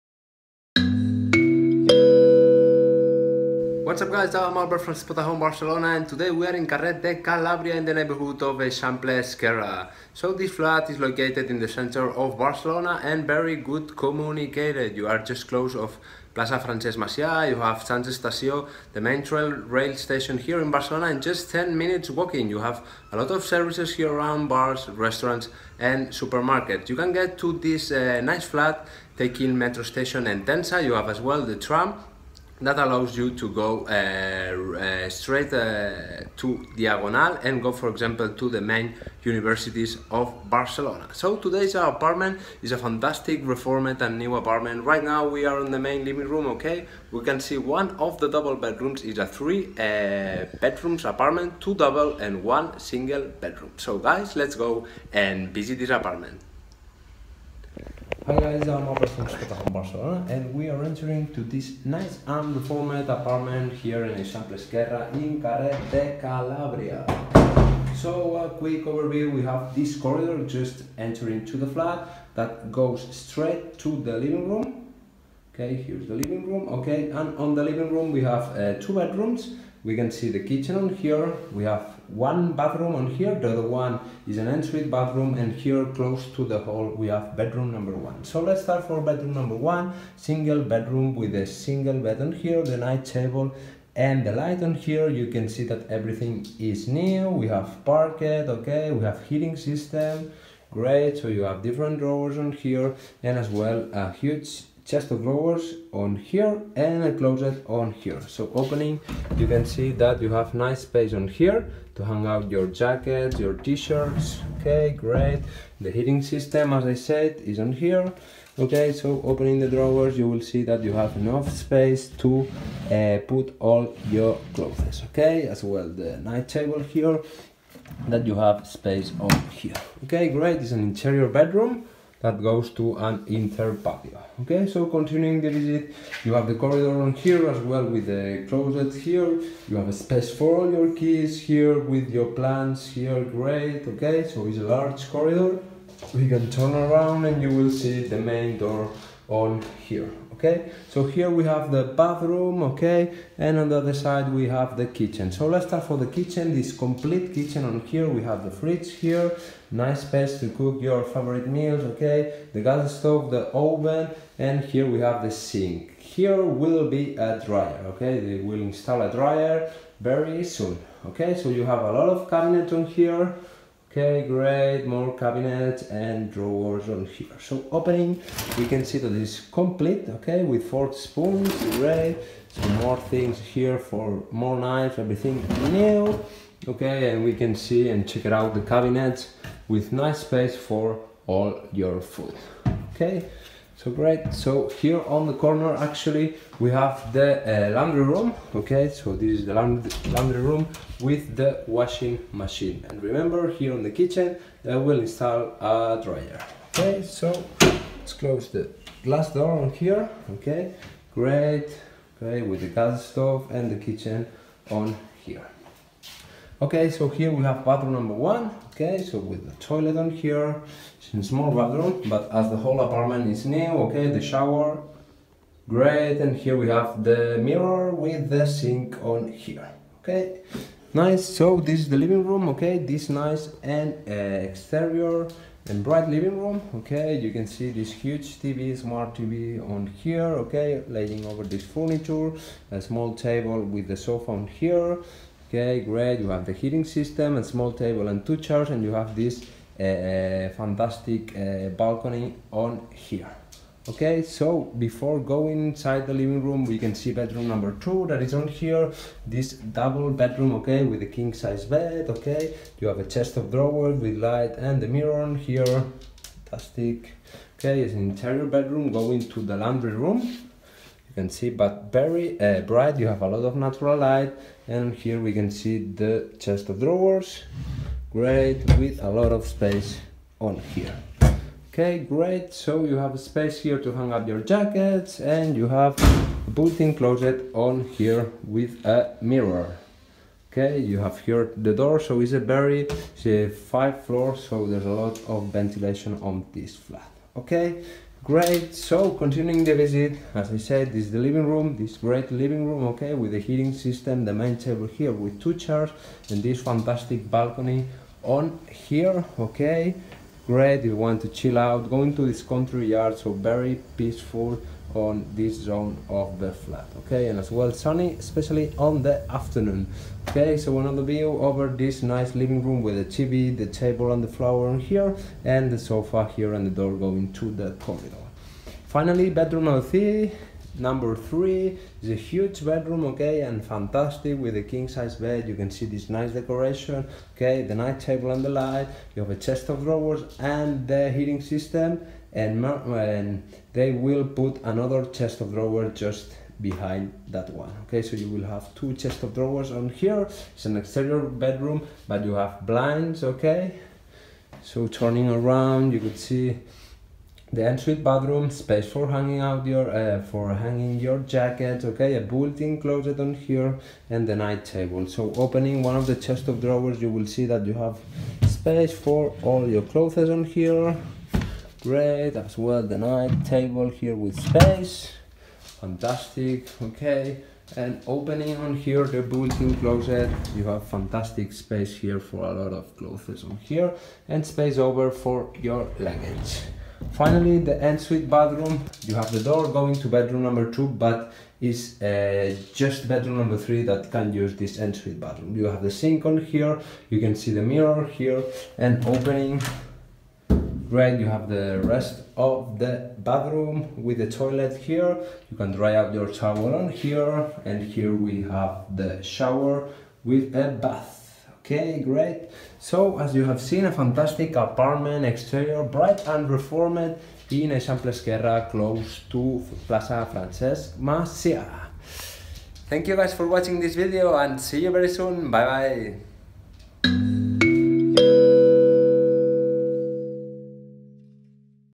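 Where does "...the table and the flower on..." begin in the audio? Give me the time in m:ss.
5:23.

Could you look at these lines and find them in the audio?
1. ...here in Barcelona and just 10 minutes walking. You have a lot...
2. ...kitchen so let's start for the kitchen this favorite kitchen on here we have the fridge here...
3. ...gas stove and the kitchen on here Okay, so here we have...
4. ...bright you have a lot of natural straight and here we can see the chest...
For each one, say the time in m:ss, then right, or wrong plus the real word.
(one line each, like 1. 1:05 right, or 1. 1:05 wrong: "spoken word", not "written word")
1. 0:20 right
2. 2:34 wrong: "complete", not "favorite"
3. 3:32 right
4. 4:32 wrong: "light", not "straight".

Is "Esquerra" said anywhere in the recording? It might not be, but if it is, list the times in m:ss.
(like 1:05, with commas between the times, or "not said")
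0:09, 1:04, 6:58.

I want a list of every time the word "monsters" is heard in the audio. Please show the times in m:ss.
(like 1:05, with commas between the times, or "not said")
not said.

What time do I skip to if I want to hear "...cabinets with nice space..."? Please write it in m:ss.
3:08.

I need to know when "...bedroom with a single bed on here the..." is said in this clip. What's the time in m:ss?
1:30.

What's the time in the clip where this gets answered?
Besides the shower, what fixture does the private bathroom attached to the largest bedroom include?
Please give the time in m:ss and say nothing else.
6:50.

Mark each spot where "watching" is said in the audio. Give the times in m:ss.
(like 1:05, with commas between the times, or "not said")
7:03.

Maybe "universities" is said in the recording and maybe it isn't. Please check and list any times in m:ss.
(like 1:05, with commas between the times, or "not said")
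0:39.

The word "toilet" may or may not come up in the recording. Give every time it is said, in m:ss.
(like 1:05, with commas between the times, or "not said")
3:39, 6:44.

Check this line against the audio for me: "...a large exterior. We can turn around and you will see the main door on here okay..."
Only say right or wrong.
wrong.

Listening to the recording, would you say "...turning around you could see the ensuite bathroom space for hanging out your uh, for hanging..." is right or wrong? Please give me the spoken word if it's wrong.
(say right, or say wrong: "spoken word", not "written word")
right.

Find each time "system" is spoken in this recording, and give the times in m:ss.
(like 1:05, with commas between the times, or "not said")
1:39, 1:56, 4:06, 5:03, 5:41.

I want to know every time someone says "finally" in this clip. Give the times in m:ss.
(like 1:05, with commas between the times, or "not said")
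5:28, 6:27.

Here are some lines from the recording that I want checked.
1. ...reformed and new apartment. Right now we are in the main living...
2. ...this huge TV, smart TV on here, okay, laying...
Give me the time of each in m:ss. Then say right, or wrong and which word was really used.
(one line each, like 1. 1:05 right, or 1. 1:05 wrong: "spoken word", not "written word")
1. 0:43 right
2. 3:57 right.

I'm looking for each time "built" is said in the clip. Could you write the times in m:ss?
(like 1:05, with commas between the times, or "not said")
4:46, 6:02, 6:19.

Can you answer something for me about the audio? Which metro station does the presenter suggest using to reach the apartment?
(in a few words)
Entença.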